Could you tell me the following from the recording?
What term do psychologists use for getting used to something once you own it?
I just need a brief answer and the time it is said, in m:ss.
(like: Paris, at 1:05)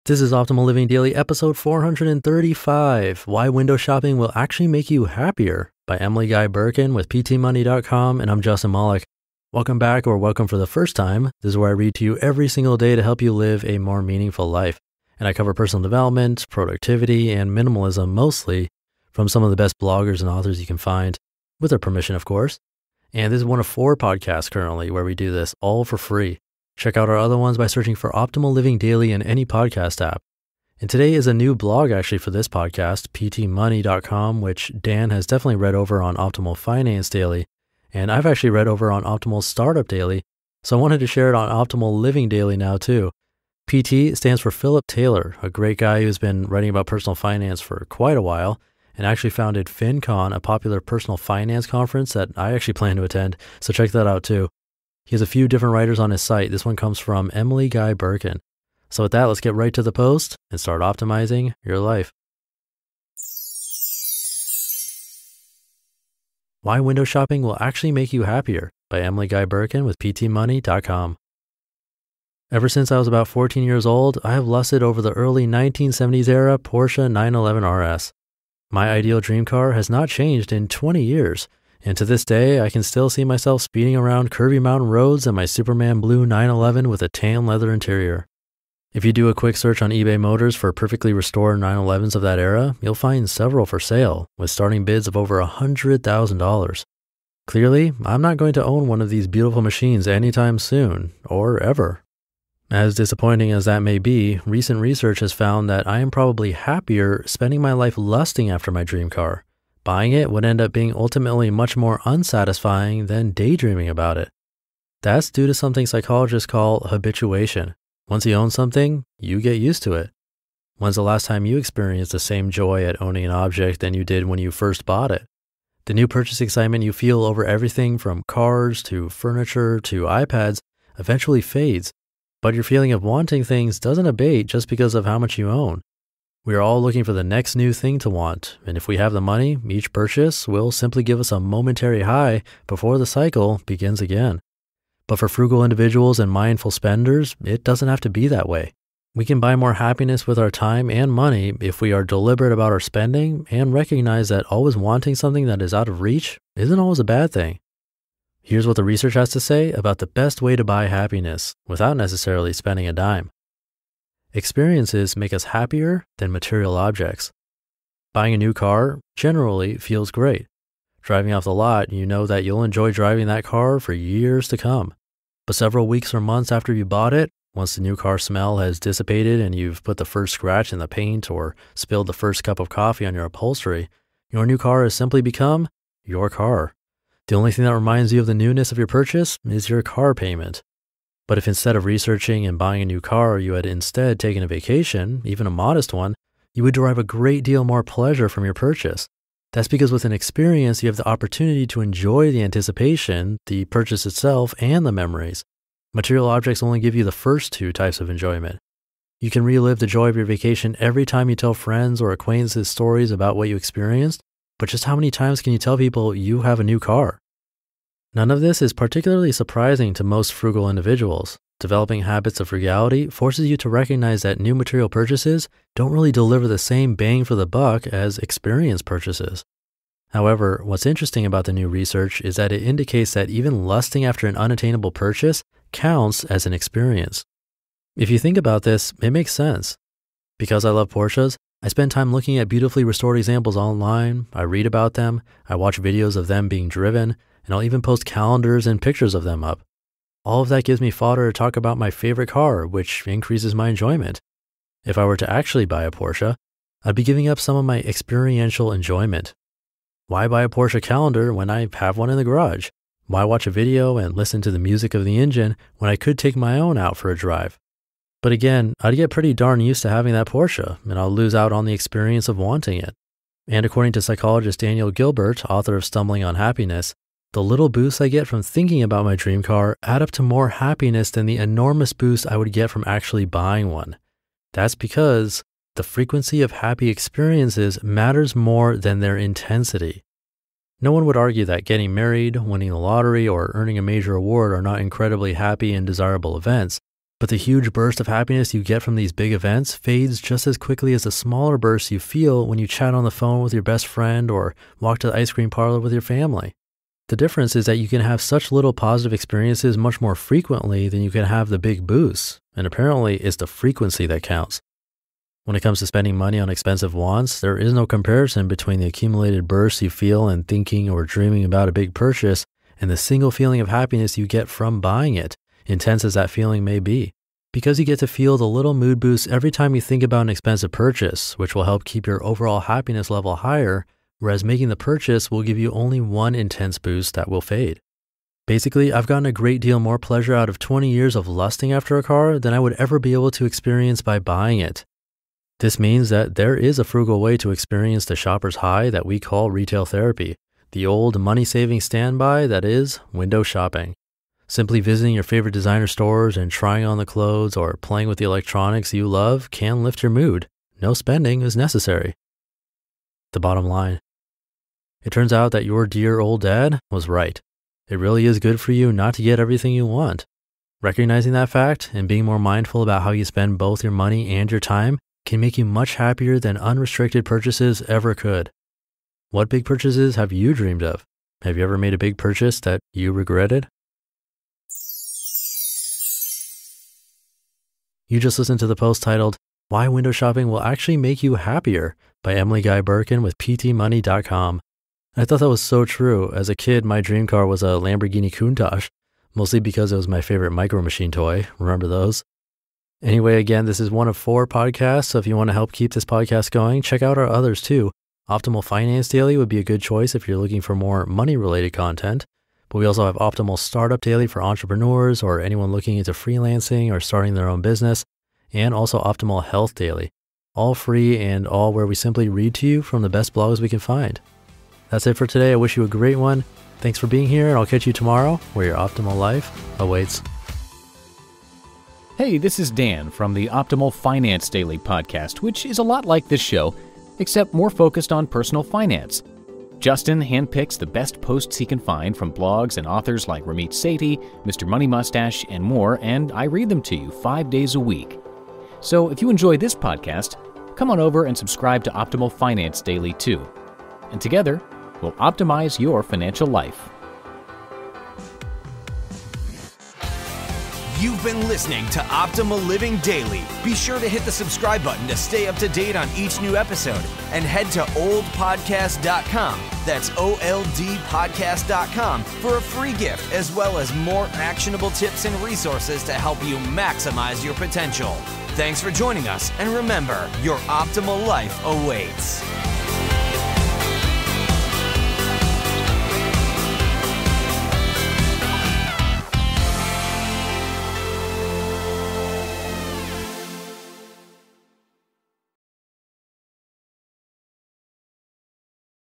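habituation, at 1:56.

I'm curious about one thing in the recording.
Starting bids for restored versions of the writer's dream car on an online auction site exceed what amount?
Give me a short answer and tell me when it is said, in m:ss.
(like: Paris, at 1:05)
$100,000, at 1:35.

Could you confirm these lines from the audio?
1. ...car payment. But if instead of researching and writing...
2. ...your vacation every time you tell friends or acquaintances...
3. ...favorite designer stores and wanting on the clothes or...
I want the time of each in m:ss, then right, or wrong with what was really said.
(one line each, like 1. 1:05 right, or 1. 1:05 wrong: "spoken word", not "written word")
1. 3:09 wrong: "buying", not "writing"
2. 3:30 right
3. 5:55 wrong: "trying", not "wanting".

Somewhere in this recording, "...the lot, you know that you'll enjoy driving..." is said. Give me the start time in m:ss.
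2:51.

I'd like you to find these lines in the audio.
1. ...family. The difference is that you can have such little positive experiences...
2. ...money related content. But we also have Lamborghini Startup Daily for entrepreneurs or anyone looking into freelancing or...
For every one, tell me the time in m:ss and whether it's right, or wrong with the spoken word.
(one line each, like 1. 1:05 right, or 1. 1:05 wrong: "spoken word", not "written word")
1. 5:06 right
2. 6:51 wrong: "Optimal", not "Lamborghini".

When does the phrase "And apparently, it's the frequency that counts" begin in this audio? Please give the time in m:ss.
5:12.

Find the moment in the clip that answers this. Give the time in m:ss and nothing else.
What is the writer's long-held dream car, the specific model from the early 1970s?
1:16.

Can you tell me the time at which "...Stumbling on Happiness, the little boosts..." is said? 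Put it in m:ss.
4:35.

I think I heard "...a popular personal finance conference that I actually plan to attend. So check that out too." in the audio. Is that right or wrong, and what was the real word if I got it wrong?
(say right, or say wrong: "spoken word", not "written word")
right.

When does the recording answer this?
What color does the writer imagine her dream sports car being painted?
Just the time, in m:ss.
1:25.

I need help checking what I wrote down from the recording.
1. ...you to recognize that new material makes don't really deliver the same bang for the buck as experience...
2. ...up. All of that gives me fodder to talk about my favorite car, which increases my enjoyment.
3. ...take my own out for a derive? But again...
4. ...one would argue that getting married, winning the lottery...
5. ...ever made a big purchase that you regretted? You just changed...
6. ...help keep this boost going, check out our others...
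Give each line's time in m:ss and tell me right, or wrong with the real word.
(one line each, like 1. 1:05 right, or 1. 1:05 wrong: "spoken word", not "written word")
1. 3:43 wrong: "purchases", not "makes"
2. 4:09 right
3. 4:26 wrong: "drive", not "derive"
4. 4:50 right
5. 6:21 wrong: "listened", not "changed"
6. 6:45 wrong: "podcast", not "boost".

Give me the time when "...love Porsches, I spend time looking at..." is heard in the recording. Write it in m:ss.
4:00.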